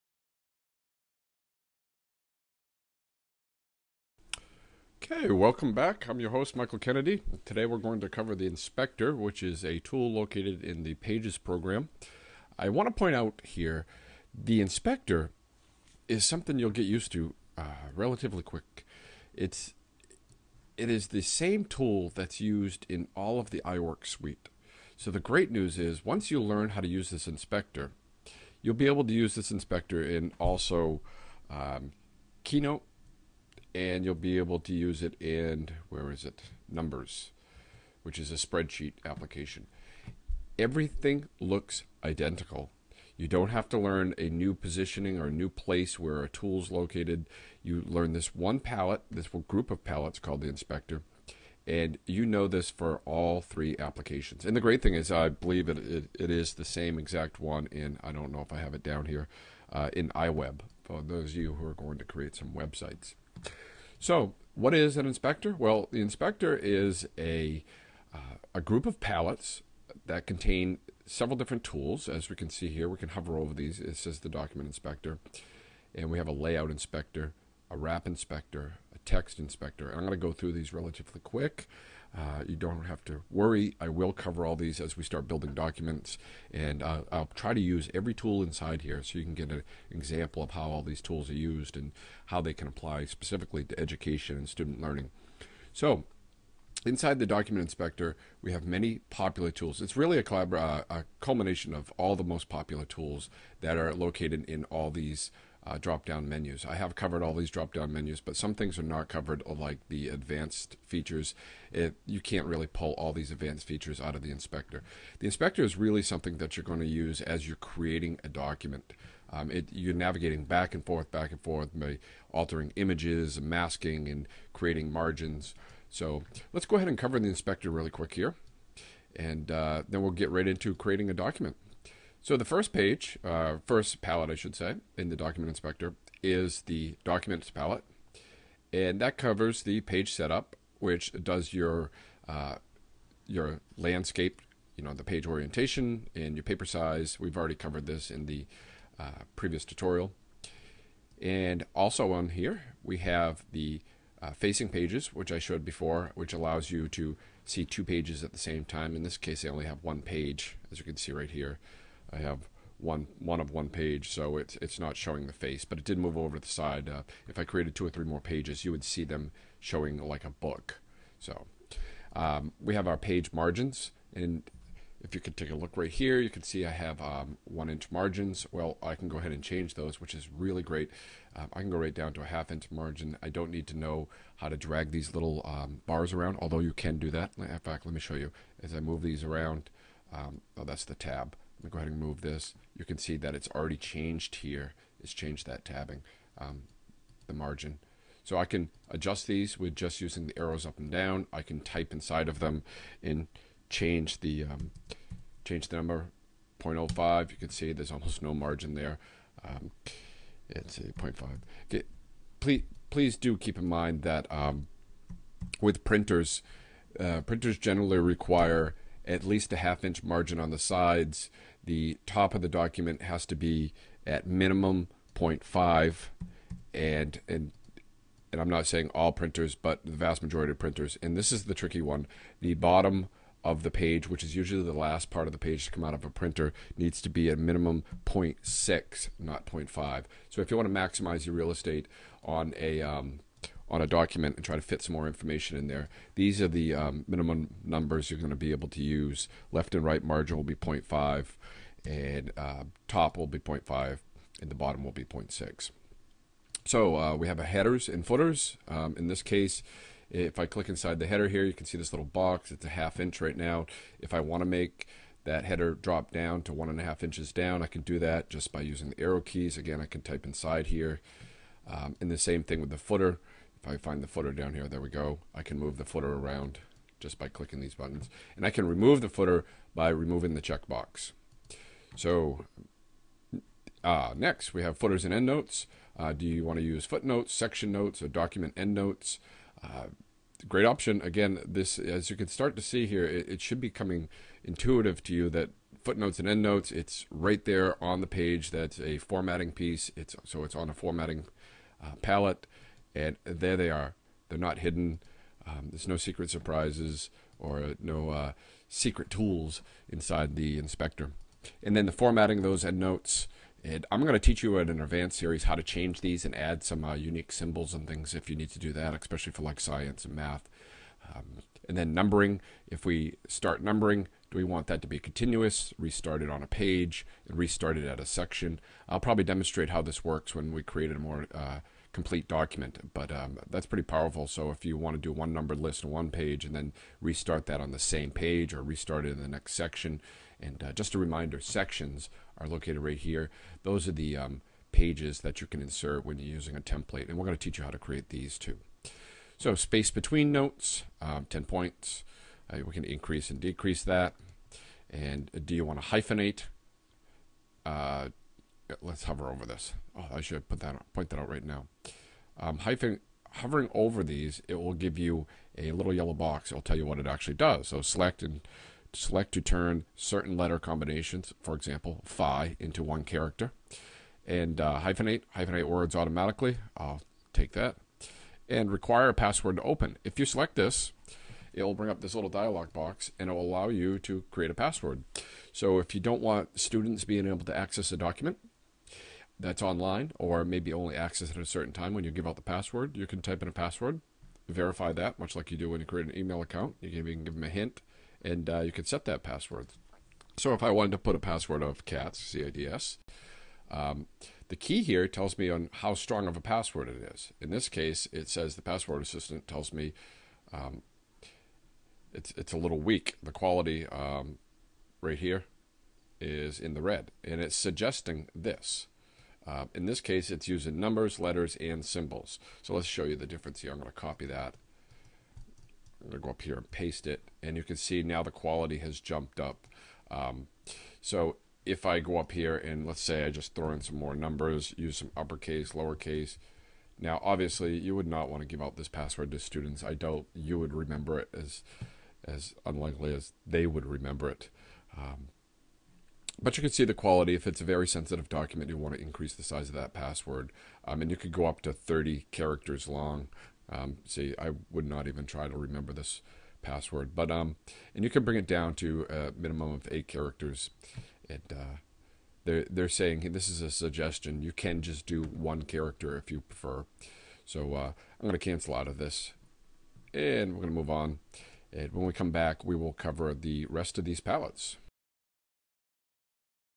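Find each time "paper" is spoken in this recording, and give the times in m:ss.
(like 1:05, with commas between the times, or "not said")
2:26.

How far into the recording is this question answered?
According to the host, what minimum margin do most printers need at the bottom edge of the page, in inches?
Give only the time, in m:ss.
3:58.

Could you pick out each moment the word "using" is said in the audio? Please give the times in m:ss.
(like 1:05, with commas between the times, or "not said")
3:20, 4:28, 5:46, 7:00.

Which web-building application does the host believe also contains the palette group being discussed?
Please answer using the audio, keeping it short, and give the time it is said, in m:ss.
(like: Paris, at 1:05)
iWeb, at 1:00.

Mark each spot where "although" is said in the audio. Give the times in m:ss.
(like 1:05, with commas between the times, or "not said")
3:06.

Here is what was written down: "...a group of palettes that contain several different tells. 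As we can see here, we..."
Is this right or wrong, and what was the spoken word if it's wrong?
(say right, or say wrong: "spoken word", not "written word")
wrong: "tools", not "tells".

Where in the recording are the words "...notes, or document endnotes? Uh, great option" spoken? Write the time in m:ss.
4:47.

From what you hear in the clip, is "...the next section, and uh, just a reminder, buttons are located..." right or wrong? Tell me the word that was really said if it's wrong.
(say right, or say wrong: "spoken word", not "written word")
wrong: "sections", not "buttons".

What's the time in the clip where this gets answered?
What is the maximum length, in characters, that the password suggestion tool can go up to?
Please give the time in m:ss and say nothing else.
7:31.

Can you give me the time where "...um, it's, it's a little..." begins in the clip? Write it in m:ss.
6:50.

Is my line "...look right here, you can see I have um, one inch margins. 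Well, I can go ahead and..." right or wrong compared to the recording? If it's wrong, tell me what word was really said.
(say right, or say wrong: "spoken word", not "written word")
right.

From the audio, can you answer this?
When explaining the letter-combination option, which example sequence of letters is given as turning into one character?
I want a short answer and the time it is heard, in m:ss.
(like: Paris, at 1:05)
phi, at 6:12.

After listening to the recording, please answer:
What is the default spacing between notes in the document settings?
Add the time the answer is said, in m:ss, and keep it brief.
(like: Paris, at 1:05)
10 points, at 5:51.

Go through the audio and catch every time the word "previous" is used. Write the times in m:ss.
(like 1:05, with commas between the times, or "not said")
2:29.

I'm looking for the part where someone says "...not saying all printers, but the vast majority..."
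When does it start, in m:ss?
3:48.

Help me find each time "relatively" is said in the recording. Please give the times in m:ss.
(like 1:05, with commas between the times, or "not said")
0:17, 1:20.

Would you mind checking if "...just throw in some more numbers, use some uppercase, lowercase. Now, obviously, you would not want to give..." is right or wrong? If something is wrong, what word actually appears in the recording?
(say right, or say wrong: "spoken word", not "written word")
right.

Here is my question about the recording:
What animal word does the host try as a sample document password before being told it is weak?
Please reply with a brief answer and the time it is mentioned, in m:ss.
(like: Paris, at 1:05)
cats, at 6:41.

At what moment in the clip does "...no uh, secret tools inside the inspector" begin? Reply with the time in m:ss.
5:07.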